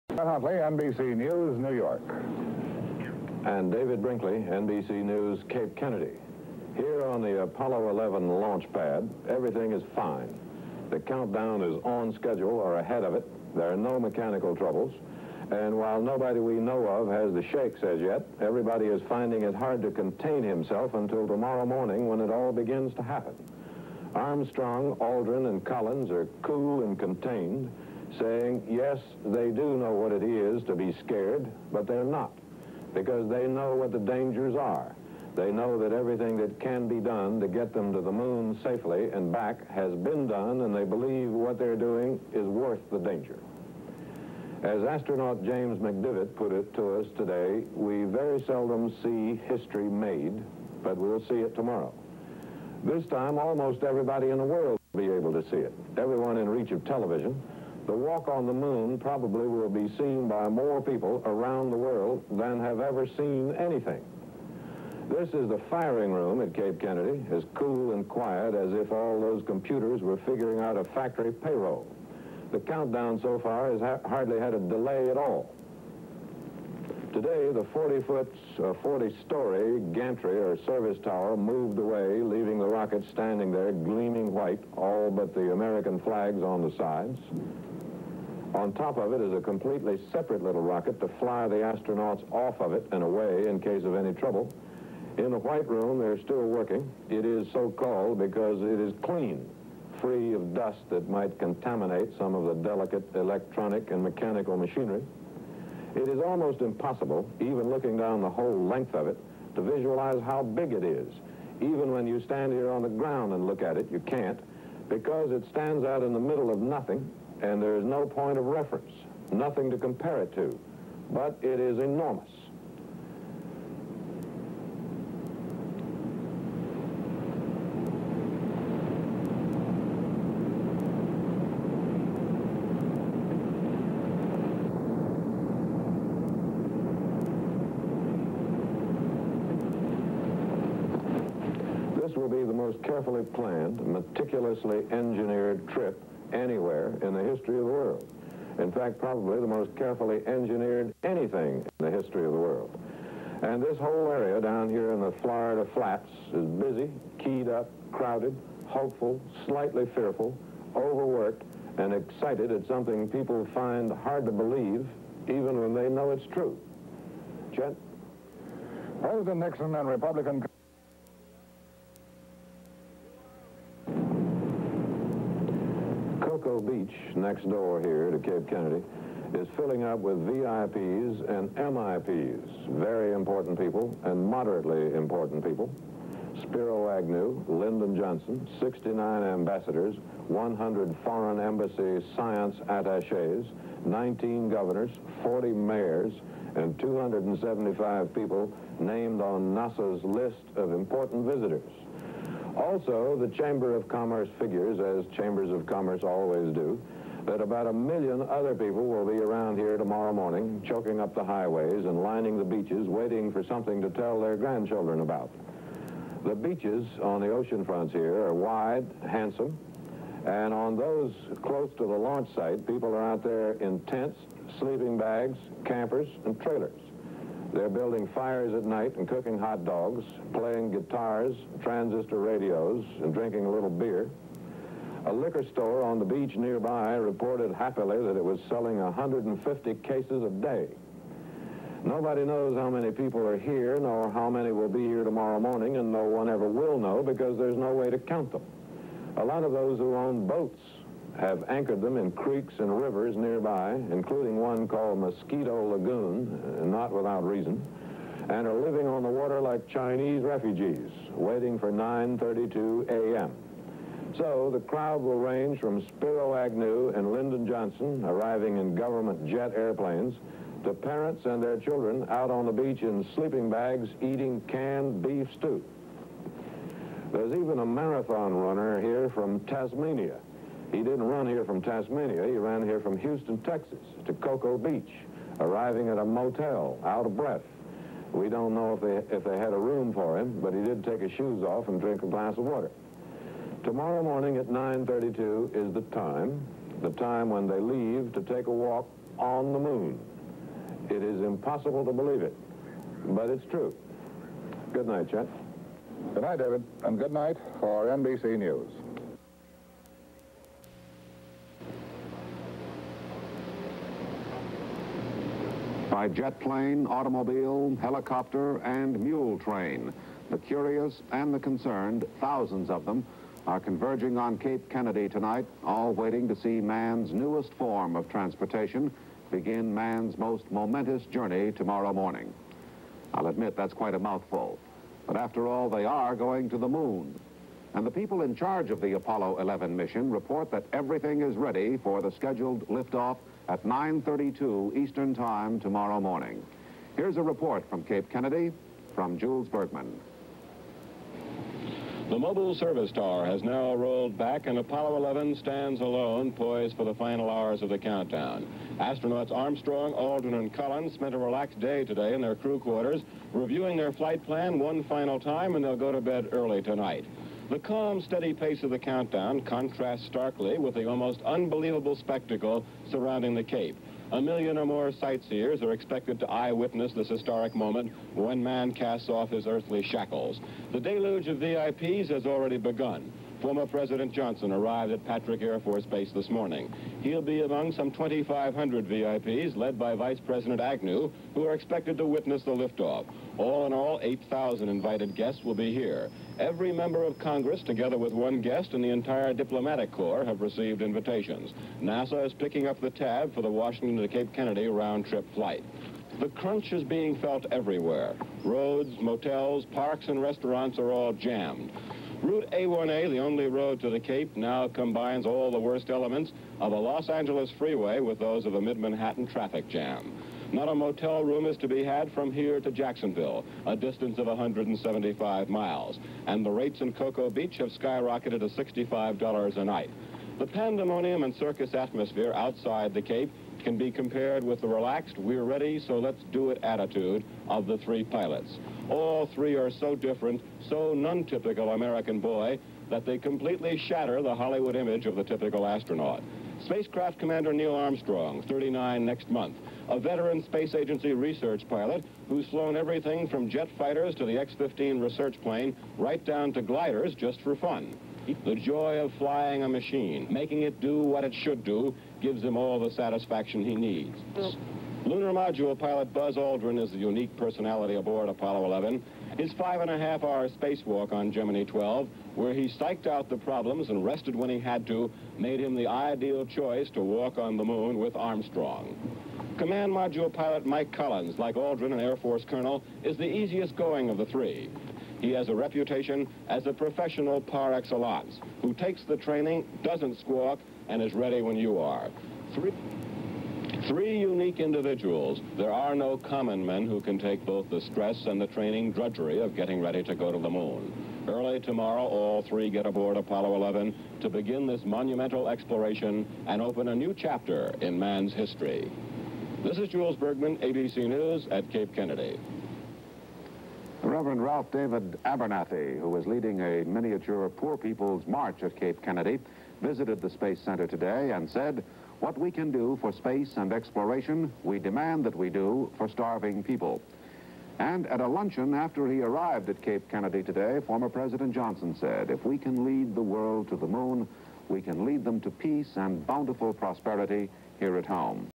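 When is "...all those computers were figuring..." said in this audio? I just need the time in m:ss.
1:08.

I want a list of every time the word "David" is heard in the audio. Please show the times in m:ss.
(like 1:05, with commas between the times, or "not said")
0:03, 5:06, 8:34.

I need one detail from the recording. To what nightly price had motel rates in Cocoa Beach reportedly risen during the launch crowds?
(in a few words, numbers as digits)
$65.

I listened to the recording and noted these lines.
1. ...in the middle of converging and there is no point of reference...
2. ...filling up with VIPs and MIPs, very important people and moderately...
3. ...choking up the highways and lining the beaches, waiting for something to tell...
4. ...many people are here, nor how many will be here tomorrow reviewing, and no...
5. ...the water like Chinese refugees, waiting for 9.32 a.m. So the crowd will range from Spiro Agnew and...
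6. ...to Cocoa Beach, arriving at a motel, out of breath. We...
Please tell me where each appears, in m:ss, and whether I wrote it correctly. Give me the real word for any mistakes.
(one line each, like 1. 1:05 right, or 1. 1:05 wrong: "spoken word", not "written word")
1. 1:56 wrong: "nothing", not "converging"
2. 2:59 right
3. 3:30 right
4. 4:02 wrong: "morning", not "reviewing"
5. 4:19 right
6. 4:44 right.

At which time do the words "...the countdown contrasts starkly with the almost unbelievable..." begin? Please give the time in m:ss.
6:08.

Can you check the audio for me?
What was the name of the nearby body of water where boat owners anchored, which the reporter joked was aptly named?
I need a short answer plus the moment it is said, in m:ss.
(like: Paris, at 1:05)
Mosquito Lagoon, at 4:14.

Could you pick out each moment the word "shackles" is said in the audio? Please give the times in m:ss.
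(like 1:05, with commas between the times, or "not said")
6:19.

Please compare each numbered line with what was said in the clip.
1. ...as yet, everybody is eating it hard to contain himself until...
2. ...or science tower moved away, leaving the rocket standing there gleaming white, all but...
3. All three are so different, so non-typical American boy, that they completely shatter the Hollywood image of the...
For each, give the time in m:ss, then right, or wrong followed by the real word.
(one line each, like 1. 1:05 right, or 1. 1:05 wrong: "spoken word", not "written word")
1. 0:17 wrong: "finding", not "eating"
2. 1:20 wrong: "service", not "science"
3. 7:18 right.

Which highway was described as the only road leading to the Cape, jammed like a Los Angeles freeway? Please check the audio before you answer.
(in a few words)
Route A1A.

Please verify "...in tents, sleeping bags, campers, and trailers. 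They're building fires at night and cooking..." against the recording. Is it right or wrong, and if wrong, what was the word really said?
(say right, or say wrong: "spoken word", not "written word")
right.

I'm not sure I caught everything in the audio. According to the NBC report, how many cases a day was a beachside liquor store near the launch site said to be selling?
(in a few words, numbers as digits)
150.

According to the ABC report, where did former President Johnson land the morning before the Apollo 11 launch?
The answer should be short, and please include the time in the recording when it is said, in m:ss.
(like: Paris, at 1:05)
Patrick Air Force Base, at 6:25.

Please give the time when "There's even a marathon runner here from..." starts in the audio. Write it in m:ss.
4:37.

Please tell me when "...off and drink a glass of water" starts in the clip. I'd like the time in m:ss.
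4:51.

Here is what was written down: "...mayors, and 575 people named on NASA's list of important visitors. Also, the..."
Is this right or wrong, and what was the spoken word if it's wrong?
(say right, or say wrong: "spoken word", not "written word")
wrong: "275", not "575".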